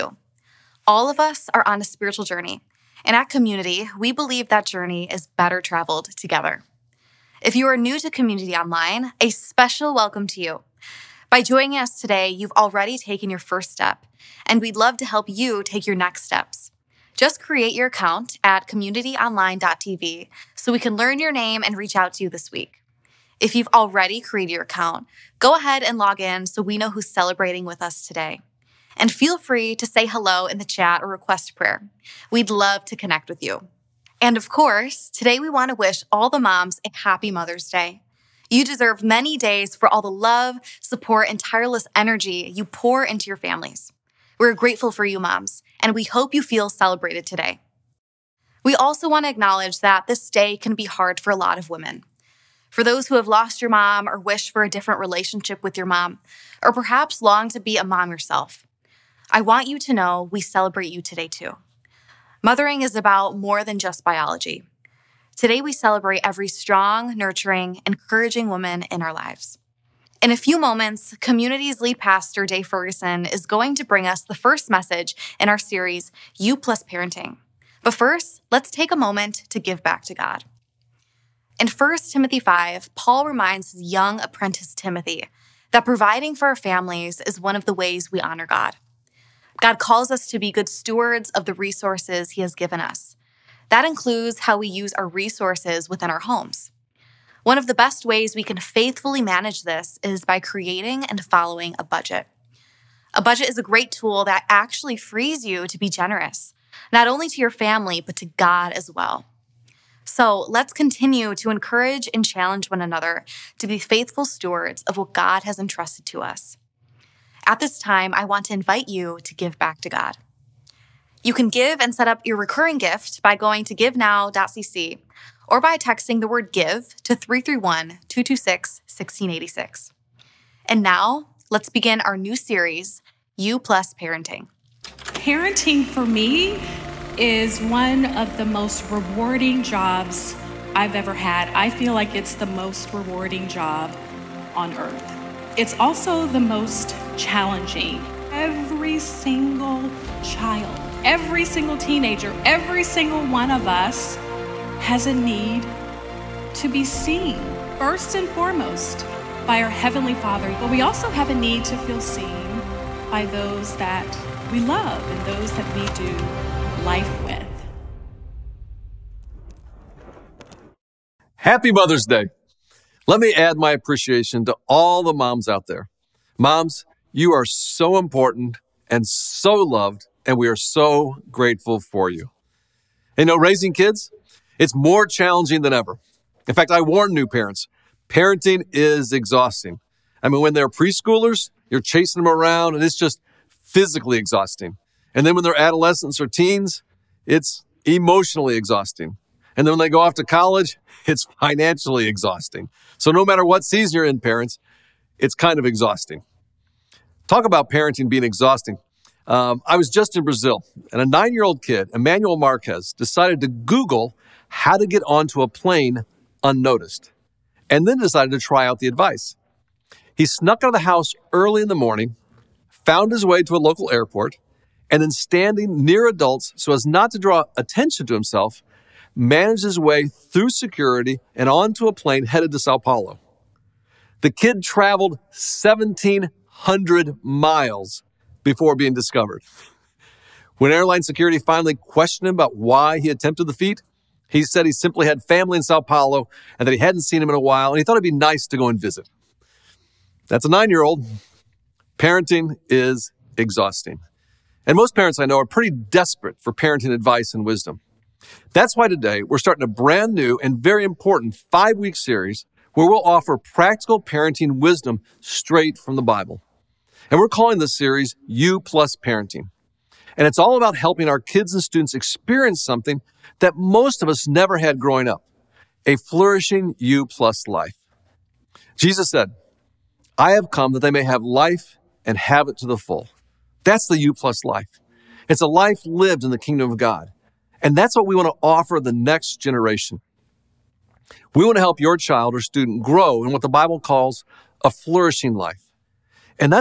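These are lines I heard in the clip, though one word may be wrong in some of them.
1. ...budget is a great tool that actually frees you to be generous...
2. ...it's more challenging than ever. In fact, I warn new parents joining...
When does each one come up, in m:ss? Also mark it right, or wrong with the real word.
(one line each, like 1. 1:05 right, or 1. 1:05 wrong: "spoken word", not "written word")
1. 1:43 right
2. 3:04 wrong: "parenting", not "joining".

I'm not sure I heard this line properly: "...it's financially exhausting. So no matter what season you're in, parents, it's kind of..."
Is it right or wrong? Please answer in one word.
right.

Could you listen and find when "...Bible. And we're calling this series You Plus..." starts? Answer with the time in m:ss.
4:26.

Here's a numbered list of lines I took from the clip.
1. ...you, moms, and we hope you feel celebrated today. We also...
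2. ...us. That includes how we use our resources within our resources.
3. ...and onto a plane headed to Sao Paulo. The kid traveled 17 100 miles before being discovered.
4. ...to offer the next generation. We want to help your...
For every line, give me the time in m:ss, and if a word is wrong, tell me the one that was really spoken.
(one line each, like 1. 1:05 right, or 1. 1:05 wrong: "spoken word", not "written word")
1. 0:45 right
2. 1:32 wrong: "homes", not "resources"
3. 3:51 right
4. 4:48 right.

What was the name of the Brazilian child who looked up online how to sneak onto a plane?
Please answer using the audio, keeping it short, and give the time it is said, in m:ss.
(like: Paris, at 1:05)
Emmanuel Marquez, at 3:31.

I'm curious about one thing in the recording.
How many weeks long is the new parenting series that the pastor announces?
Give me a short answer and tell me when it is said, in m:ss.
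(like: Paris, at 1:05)
5, at 4:21.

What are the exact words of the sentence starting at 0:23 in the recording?
If you've already created your account, go ahead and log in so we know who's celebrating with us today.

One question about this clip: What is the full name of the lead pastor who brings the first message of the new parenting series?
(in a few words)
Dave Ferguson.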